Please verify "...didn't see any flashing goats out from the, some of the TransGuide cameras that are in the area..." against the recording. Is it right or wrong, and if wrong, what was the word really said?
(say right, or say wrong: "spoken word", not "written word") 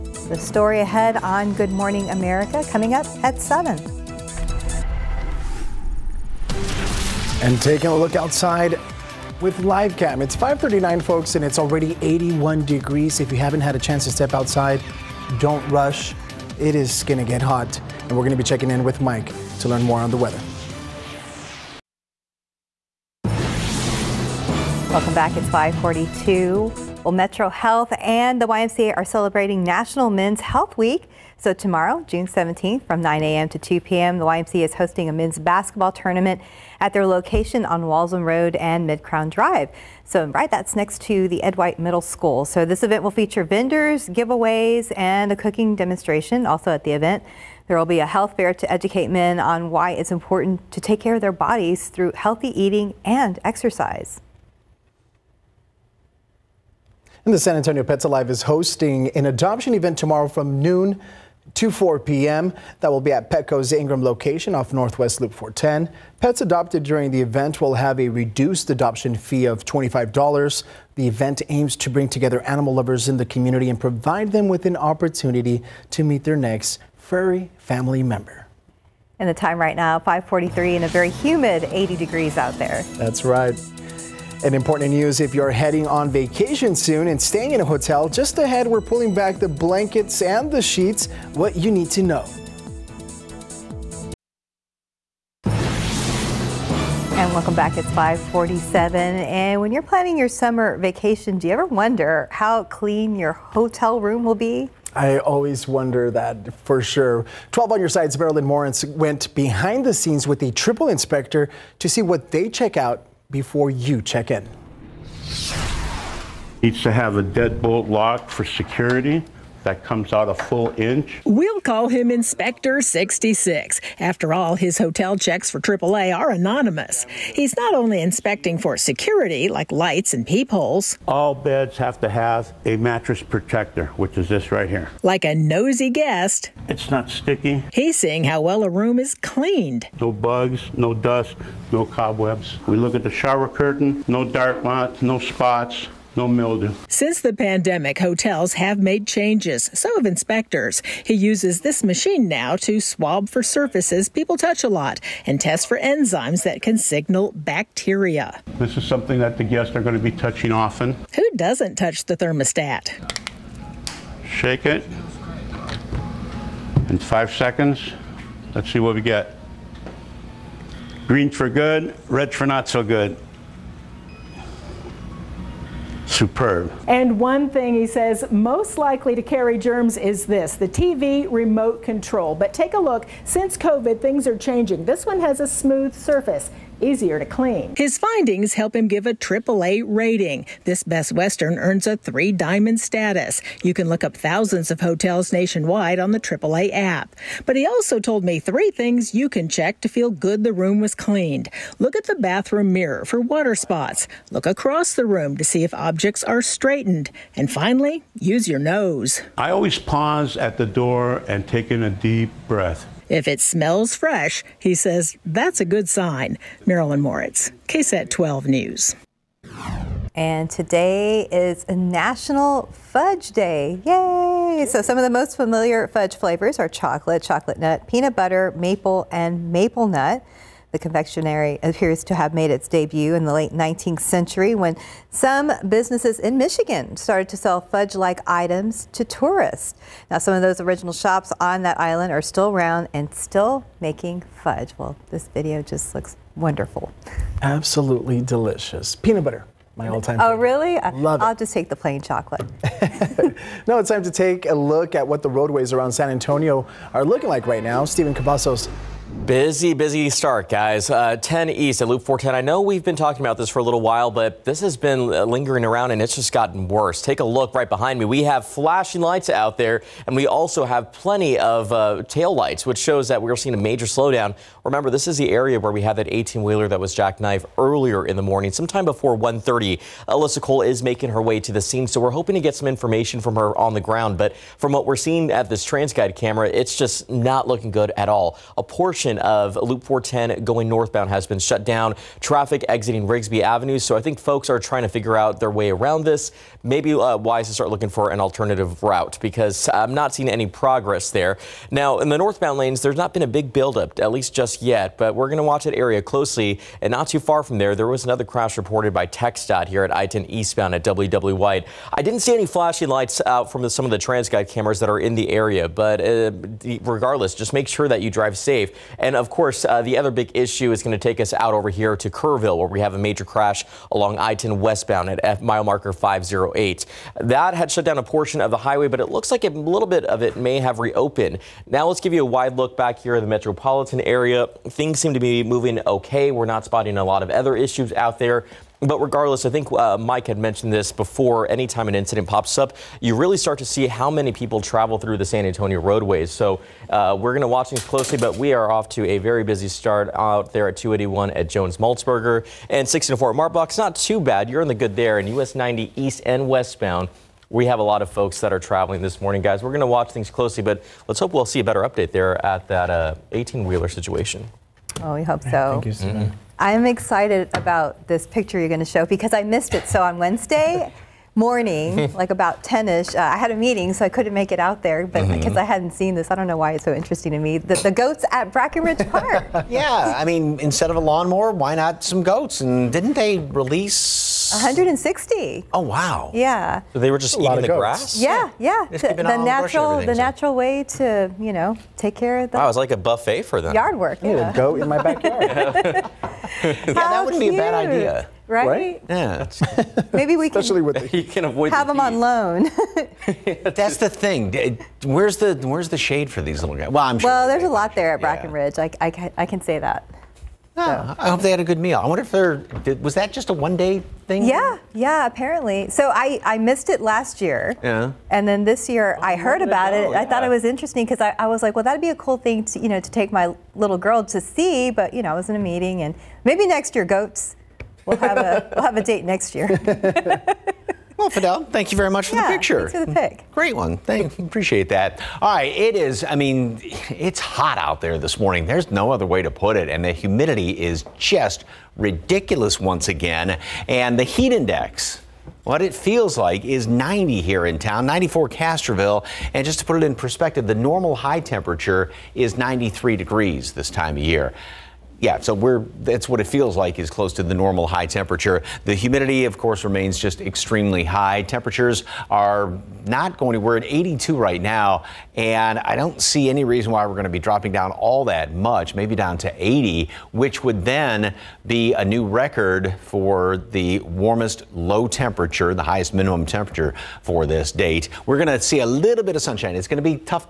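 wrong: "lights", not "goats".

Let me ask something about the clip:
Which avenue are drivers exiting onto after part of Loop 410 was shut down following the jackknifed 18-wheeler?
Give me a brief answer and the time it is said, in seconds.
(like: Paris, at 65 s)
Rigsby Avenue, at 293 s.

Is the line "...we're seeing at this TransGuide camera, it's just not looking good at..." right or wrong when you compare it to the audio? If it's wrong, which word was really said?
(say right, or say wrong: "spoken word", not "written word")
right.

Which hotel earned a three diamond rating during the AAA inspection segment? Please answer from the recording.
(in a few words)
Best Western.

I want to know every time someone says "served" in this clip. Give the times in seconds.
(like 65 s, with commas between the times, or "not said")
not said.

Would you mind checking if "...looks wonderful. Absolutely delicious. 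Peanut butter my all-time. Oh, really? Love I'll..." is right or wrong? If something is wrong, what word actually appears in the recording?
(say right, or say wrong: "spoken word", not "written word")
right.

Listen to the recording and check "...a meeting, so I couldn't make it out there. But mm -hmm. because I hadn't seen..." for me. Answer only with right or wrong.
right.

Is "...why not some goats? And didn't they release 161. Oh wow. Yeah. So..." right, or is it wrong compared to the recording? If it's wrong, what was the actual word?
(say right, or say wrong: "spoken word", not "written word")
wrong: "160", not "161".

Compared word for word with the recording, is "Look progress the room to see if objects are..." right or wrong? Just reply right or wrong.
wrong.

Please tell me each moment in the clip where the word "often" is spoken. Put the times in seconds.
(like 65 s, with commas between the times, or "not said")
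160 s.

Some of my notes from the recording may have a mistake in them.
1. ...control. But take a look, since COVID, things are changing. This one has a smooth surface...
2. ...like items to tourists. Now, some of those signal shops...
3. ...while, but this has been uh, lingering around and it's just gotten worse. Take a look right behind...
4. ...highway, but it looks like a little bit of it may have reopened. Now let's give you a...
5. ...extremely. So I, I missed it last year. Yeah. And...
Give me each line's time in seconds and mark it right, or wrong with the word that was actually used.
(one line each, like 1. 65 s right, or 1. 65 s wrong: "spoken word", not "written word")
1. 181 s right
2. 237 s wrong: "original", not "signal"
3. 263 s right
4. 328 s right
5. 415 s wrong: "apparently", not "extremely".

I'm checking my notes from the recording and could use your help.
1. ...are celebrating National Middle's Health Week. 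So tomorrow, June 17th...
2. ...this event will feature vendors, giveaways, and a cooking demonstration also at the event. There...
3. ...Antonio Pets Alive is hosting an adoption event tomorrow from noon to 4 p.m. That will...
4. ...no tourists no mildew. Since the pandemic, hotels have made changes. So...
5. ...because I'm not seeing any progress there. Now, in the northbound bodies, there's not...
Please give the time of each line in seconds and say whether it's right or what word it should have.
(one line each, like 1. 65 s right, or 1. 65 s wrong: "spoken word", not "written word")
1. 28 s wrong: "Men", not "Middle"
2. 42 s right
3. 57 s right
4. 145 s wrong: "spots", not "tourists"
5. 299 s wrong: "lanes", not "bodies".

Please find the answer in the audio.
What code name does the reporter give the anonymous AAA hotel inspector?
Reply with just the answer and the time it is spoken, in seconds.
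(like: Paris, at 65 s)
Inspector 66, at 122 s.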